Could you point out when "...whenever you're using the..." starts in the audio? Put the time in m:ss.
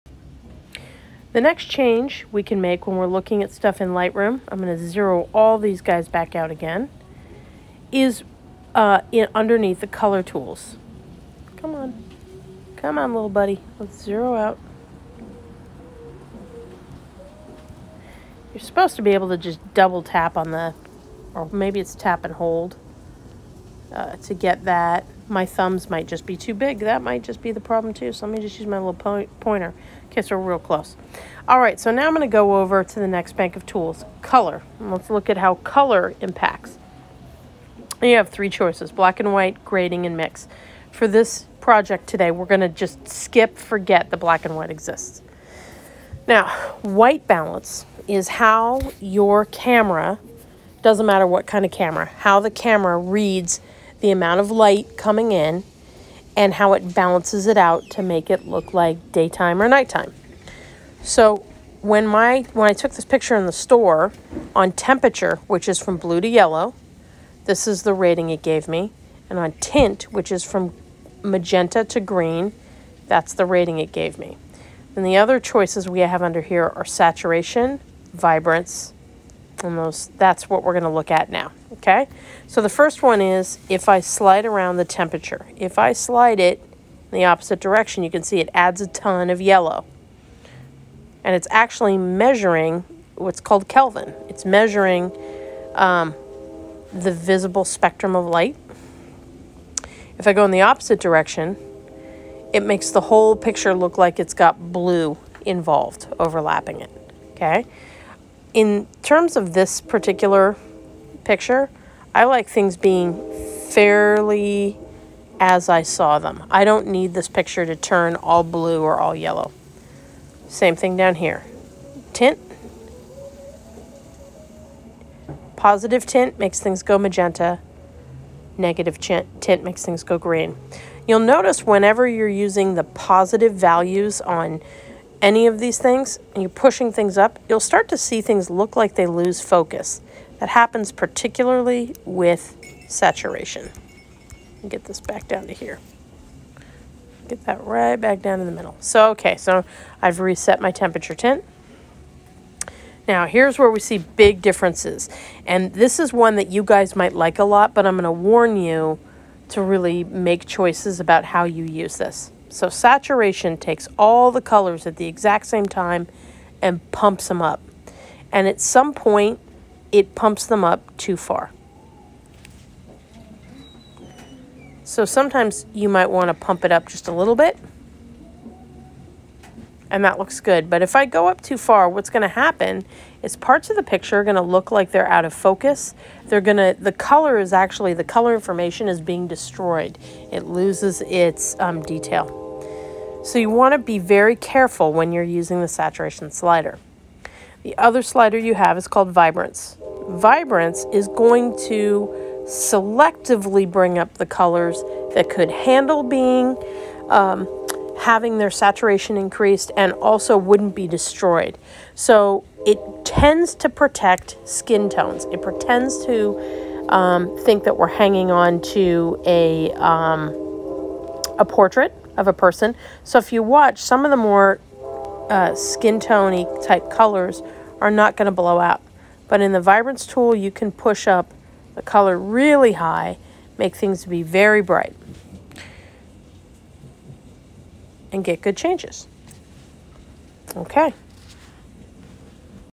2:11.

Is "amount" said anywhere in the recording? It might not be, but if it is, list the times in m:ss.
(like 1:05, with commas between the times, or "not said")
0:54.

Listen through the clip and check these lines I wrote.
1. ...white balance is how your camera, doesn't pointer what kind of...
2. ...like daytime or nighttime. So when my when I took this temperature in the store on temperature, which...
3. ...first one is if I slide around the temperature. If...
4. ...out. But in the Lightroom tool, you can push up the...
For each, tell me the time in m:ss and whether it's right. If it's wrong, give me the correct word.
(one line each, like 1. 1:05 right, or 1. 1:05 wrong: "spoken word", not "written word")
1. 0:46 wrong: "matter", not "pointer"
2. 0:58 wrong: "picture", not "temperature"
3. 1:22 right
4. 3:48 wrong: "Vibrance", not "Lightroom".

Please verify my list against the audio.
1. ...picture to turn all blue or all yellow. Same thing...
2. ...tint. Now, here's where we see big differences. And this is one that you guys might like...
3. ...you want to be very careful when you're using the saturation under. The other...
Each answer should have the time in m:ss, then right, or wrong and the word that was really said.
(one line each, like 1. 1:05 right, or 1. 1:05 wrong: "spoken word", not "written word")
1. 1:57 right
2. 2:31 right
3. 3:13 wrong: "slider", not "under".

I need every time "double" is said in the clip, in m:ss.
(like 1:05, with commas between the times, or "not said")
0:19.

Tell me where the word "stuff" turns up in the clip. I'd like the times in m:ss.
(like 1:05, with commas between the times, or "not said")
0:03.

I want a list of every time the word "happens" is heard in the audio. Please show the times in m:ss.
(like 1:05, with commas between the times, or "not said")
2:20, 3:02.